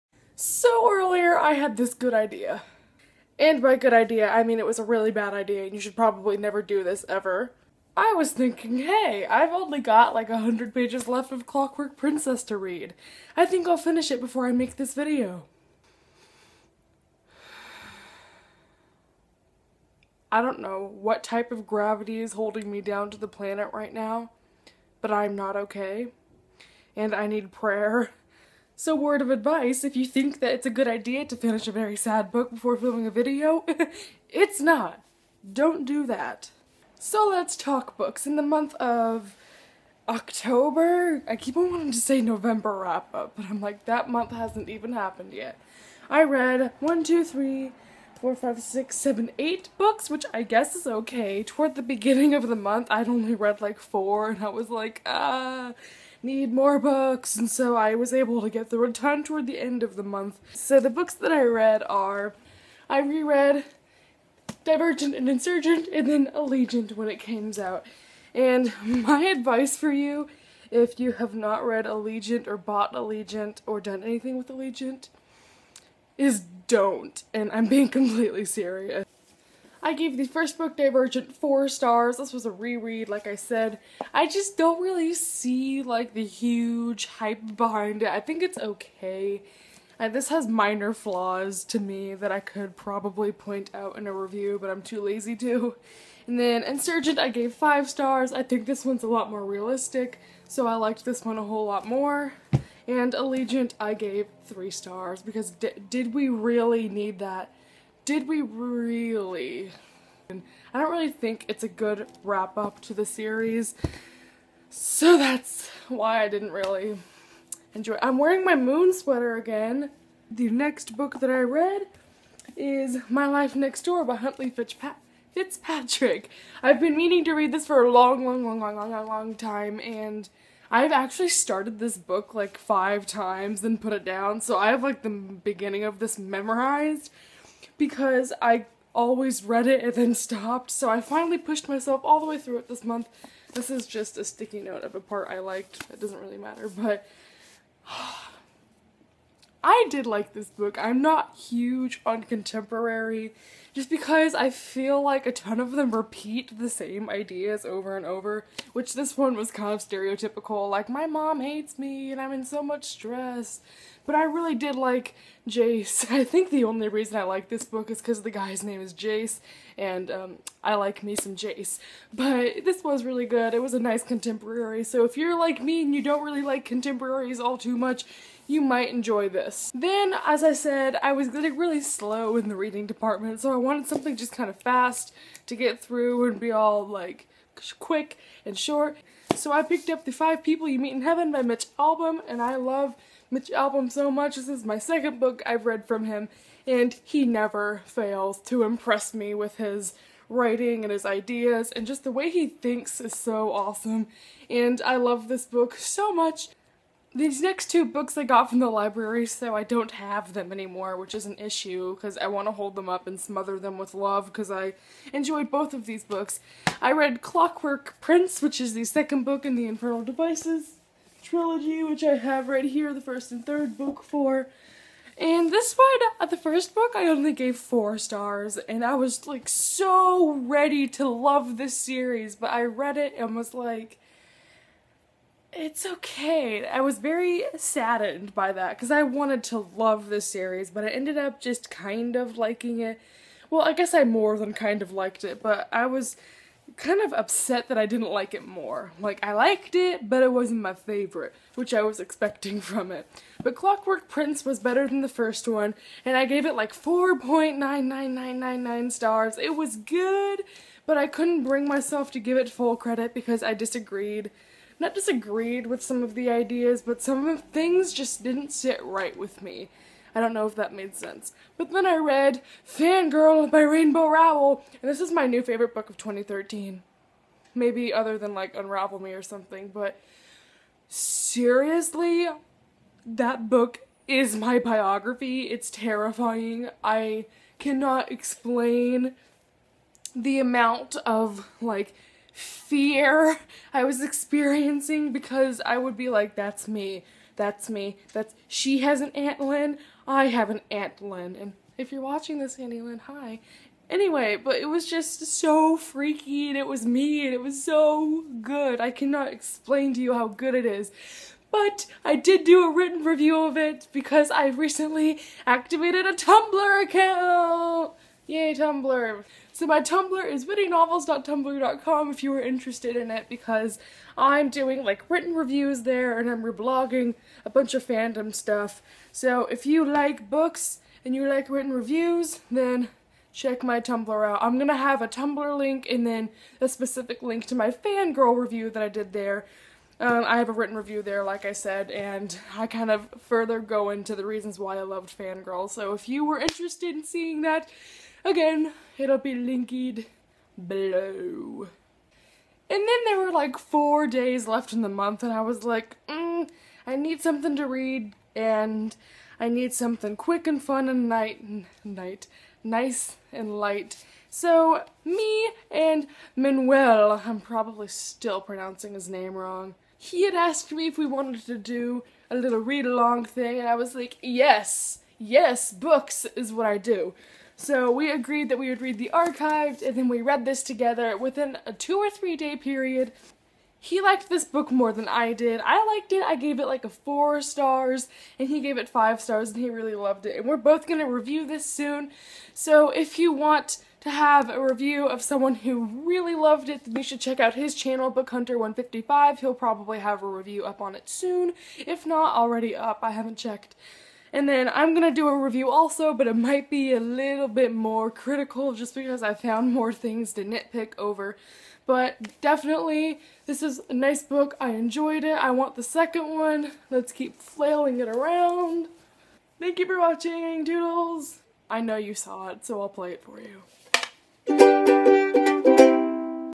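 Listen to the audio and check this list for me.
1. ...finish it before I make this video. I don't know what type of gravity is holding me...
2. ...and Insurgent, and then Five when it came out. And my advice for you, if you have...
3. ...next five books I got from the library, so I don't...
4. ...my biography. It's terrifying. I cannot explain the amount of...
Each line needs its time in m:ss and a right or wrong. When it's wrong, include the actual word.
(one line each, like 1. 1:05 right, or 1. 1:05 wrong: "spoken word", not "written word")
1. 0:13 right
2. 1:05 wrong: "Allegiant", not "Five"
3. 3:27 wrong: "two", not "five"
4. 4:44 right.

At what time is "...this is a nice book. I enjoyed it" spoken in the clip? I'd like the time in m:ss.
6:53.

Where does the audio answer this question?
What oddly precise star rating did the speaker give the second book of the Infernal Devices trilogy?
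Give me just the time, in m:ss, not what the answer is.
4:16.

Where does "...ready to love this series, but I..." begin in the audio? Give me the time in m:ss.
3:50.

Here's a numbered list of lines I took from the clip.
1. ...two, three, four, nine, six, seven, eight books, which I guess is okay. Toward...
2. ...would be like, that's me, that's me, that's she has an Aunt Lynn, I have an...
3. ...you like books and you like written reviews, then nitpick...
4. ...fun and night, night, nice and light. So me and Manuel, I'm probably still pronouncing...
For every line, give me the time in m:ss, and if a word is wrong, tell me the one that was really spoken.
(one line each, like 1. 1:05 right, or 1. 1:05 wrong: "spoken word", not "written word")
1. 0:47 wrong: "five", not "nine"
2. 4:55 right
3. 5:29 wrong: "check", not "nitpick"
4. 6:00 right.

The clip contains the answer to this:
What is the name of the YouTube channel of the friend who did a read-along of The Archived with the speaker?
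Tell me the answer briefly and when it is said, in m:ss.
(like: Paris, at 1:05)
Book Hunter 155, at 6:38.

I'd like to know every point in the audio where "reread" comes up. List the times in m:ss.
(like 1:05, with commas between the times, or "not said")
1:02, 1:22.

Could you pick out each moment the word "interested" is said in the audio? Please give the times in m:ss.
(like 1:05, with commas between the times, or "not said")
5:22, 5:46.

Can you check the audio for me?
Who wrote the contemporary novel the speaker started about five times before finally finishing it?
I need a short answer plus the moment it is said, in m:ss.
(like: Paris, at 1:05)
Huntley Fitzpatrick, at 2:04.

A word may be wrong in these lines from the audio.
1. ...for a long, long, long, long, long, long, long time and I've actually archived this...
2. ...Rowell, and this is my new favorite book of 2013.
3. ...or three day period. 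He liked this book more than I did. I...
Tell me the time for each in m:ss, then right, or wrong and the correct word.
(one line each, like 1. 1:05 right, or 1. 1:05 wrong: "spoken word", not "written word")
1. 2:07 wrong: "started", not "archived"
2. 4:34 right
3. 6:21 right.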